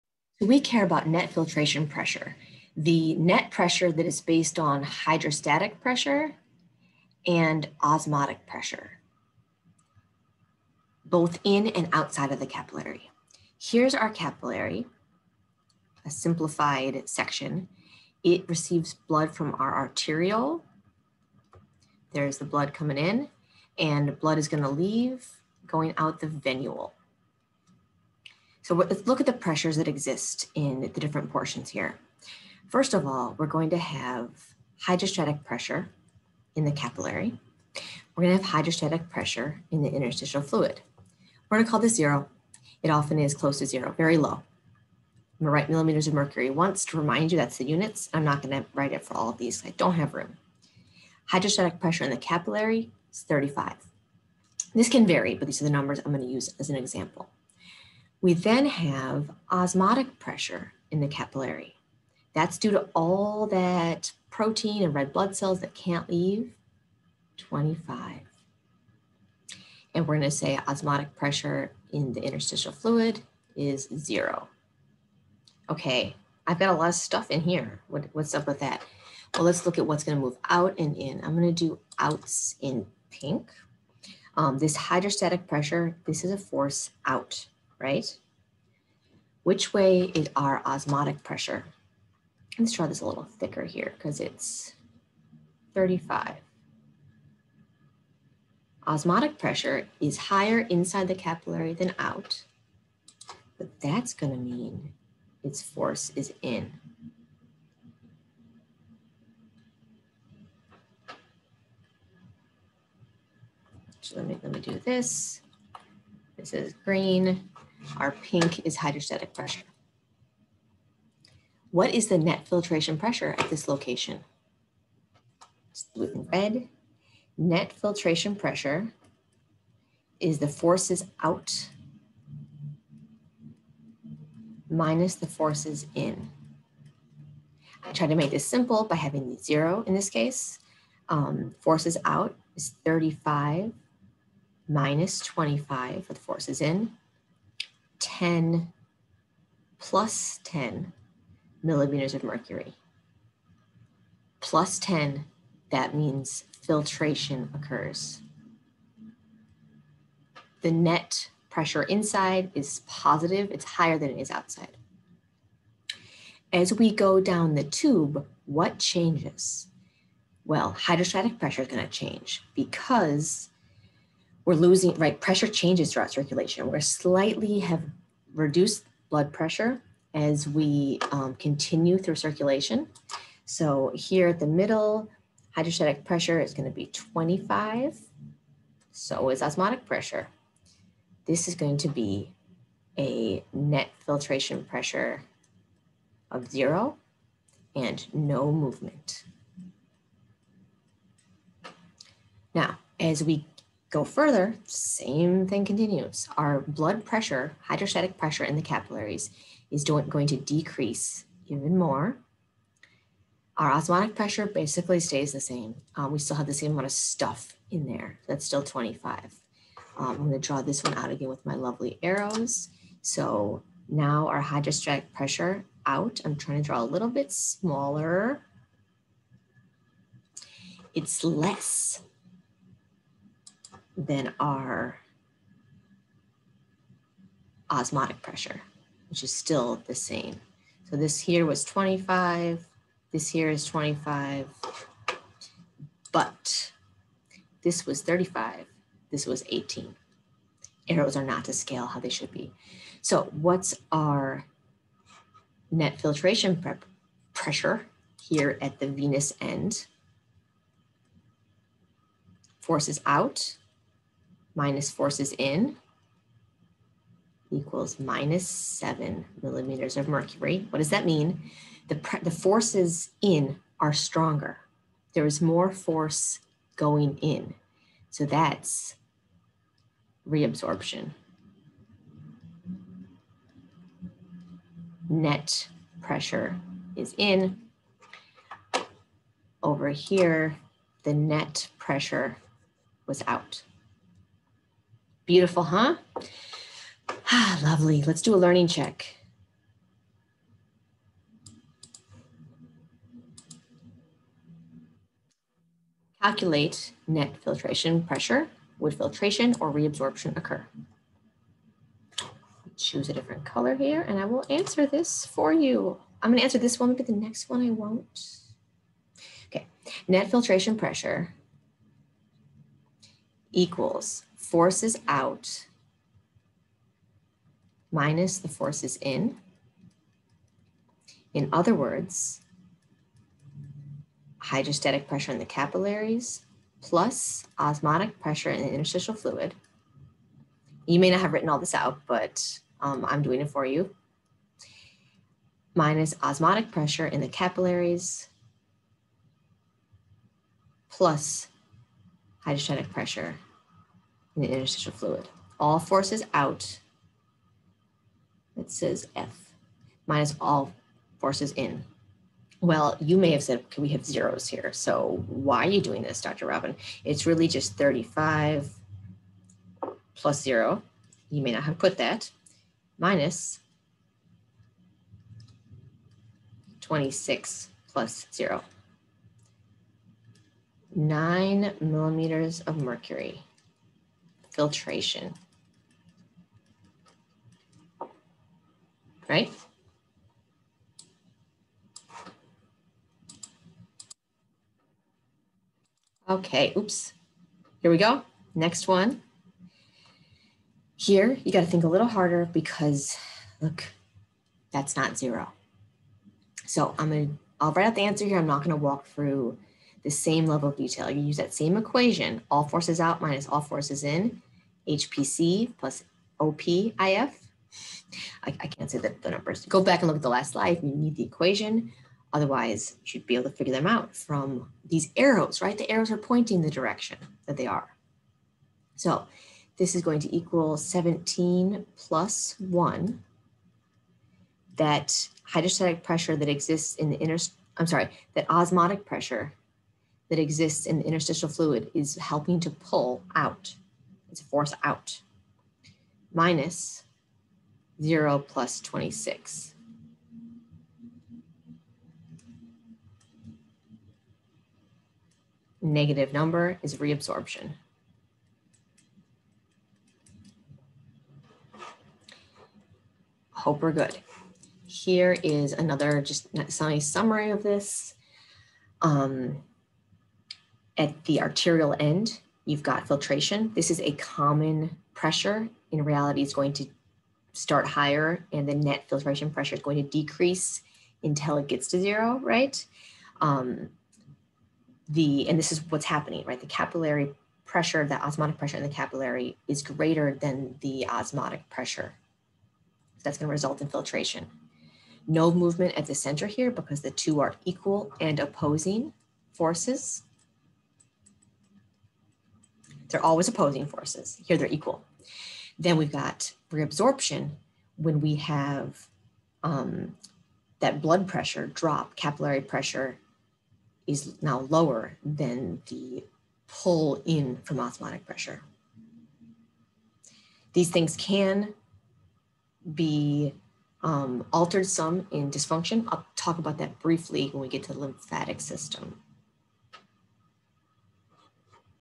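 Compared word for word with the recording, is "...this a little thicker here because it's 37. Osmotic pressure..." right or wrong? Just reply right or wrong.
wrong.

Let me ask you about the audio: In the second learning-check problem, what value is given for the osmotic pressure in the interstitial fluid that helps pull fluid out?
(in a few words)
1.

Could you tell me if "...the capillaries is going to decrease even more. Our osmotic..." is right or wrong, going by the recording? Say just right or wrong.
right.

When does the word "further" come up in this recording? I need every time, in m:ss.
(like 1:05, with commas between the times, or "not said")
3:24.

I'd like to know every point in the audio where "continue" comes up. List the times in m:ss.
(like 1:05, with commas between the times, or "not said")
3:01, 3:25.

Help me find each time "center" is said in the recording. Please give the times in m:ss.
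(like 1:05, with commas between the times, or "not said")
8:16.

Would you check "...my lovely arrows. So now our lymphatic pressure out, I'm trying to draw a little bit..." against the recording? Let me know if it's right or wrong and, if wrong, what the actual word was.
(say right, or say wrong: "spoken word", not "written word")
wrong: "hydrostatic", not "lymphatic".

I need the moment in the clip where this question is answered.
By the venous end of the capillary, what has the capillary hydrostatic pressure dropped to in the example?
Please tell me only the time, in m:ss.
4:09.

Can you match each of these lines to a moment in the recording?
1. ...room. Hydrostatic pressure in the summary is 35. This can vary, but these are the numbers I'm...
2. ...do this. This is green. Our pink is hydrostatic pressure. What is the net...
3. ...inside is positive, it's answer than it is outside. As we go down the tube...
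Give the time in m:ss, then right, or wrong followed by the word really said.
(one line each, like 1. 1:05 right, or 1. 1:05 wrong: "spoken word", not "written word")
1. 0:50 wrong: "capillary", not "summary"
2. 1:54 right
3. 2:41 wrong: "higher", not "answer".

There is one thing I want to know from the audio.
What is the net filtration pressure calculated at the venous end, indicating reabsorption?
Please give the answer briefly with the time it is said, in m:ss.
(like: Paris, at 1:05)
-7 mmHg, at 4:27.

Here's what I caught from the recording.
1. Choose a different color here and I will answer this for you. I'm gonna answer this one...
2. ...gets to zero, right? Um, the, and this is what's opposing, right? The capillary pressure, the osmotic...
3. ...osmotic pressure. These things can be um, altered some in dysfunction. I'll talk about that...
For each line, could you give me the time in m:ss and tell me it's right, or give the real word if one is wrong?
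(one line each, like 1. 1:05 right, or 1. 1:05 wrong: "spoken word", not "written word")
1. 5:12 right
2. 8:01 wrong: "happening", not "opposing"
3. 8:37 right.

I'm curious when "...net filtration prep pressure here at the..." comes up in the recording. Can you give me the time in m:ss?
4:15.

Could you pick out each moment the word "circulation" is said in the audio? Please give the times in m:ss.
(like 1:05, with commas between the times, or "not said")
2:56, 3:02.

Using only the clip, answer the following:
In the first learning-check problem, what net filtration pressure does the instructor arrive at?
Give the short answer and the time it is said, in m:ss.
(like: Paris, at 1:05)
9 mmHg, at 6:20.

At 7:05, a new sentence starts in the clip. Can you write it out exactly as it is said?
The arrows are pointing the direction that they are.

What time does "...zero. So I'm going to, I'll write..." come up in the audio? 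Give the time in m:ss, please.
6:45.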